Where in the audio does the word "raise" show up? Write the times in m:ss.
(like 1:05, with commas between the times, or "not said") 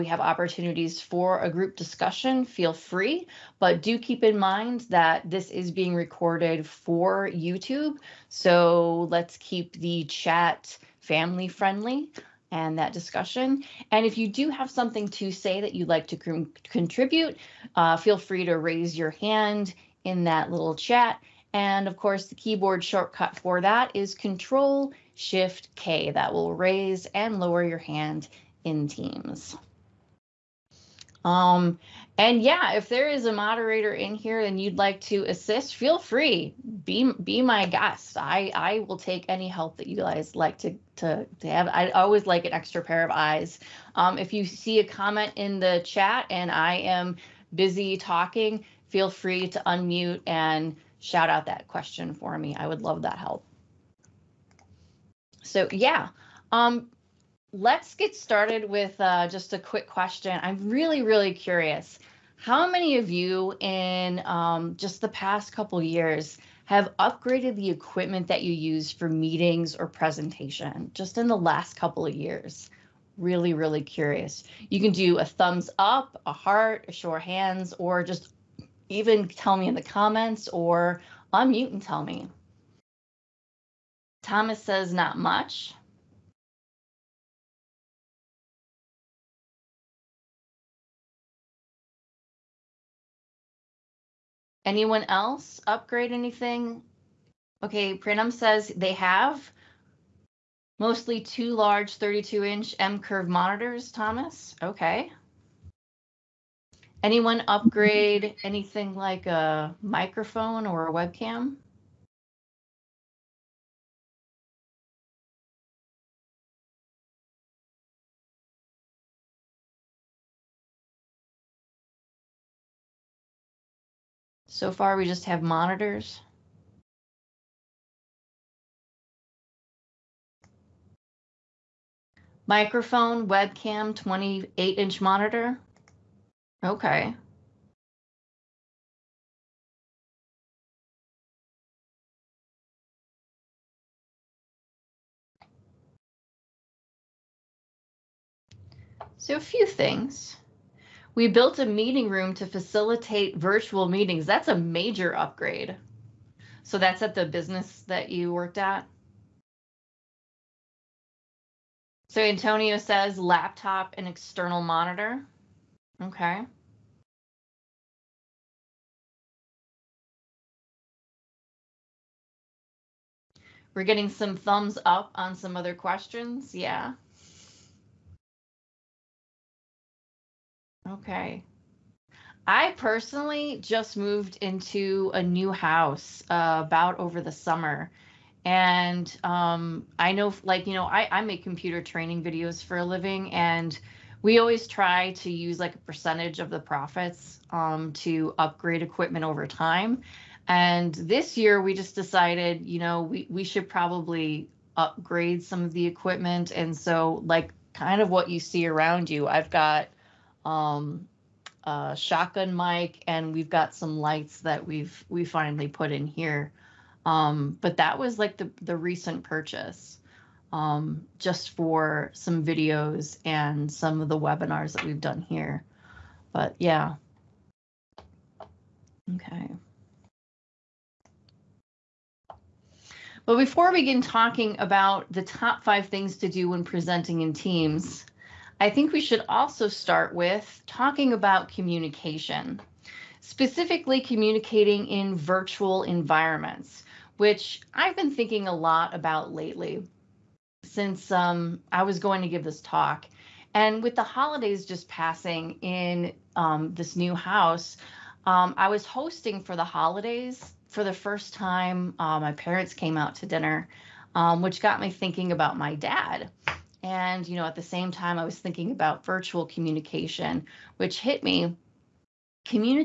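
0:18, 0:26.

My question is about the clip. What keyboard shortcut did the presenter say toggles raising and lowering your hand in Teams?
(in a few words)
Control Shift K.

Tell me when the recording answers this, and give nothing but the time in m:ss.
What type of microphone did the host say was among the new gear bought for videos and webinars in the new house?
3:31.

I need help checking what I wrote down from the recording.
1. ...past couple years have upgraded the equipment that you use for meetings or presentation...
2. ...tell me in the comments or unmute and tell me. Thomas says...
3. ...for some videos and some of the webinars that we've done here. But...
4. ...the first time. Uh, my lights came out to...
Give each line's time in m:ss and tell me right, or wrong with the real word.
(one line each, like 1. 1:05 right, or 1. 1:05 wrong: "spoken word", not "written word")
1. 1:05 right
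2. 1:19 right
3. 3:41 right
4. 4:20 wrong: "parents", not "lights".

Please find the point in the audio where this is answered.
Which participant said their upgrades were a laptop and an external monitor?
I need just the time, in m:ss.
2:42.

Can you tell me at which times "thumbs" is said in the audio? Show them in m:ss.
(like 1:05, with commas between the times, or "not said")
1:15, 2:54.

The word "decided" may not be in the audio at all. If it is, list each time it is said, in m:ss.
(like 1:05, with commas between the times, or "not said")
3:21.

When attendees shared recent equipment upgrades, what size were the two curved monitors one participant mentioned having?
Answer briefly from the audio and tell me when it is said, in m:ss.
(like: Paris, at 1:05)
32 inch, at 1:41.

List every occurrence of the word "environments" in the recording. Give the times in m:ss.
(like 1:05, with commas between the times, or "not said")
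4:05.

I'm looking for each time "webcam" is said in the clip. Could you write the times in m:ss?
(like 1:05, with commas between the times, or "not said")
1:50, 2:13.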